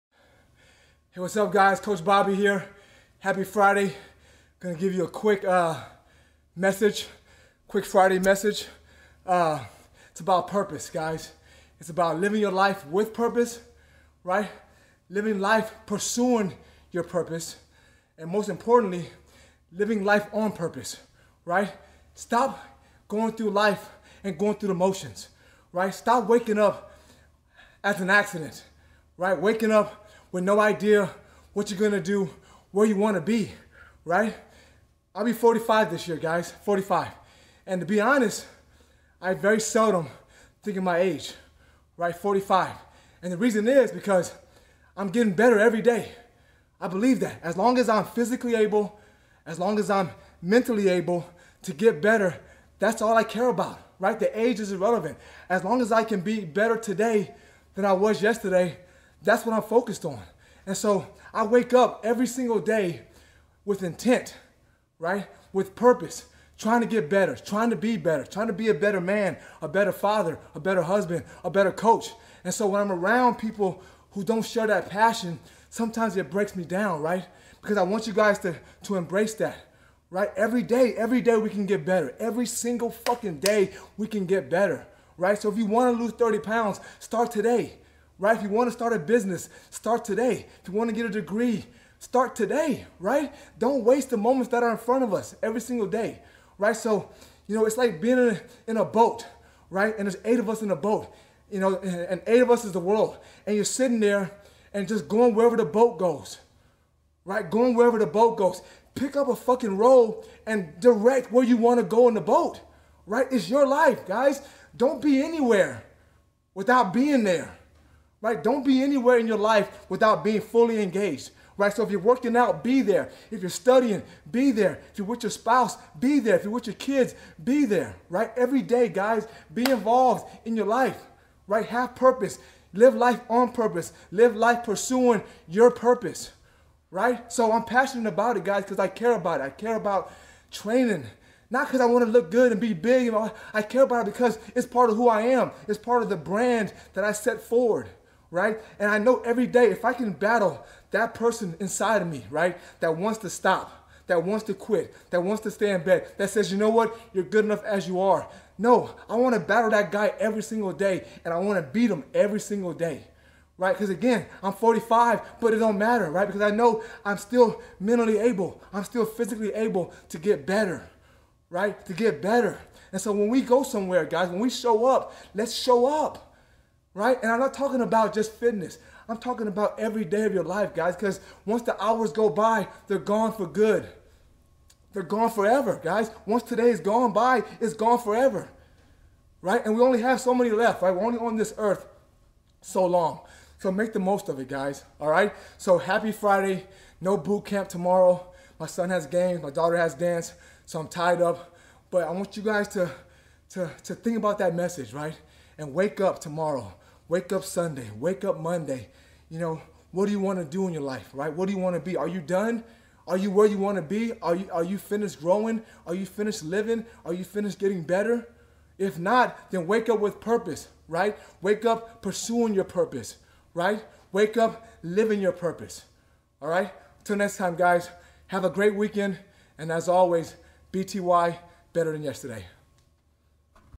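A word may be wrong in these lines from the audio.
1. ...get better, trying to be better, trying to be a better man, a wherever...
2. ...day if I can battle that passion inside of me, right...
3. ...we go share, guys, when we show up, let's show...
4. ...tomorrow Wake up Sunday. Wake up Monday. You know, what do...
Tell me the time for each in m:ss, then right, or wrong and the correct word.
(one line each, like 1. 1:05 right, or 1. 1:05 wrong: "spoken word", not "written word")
1. 1:06 wrong: "better", not "wherever"
2. 2:29 wrong: "person", not "passion"
3. 2:53 wrong: "somewhere", not "share"
4. 3:26 right.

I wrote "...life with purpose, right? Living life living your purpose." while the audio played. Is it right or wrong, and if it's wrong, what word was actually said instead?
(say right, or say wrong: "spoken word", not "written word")
wrong: "pursuing", not "living".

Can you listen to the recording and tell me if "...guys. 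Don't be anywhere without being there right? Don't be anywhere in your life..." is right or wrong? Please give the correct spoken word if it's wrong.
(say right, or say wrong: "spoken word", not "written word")
right.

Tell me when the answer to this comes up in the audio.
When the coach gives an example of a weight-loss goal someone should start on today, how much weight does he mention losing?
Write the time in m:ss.
1:26.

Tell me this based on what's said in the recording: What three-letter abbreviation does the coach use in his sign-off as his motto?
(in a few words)
BTY.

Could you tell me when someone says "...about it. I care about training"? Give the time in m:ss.
2:19.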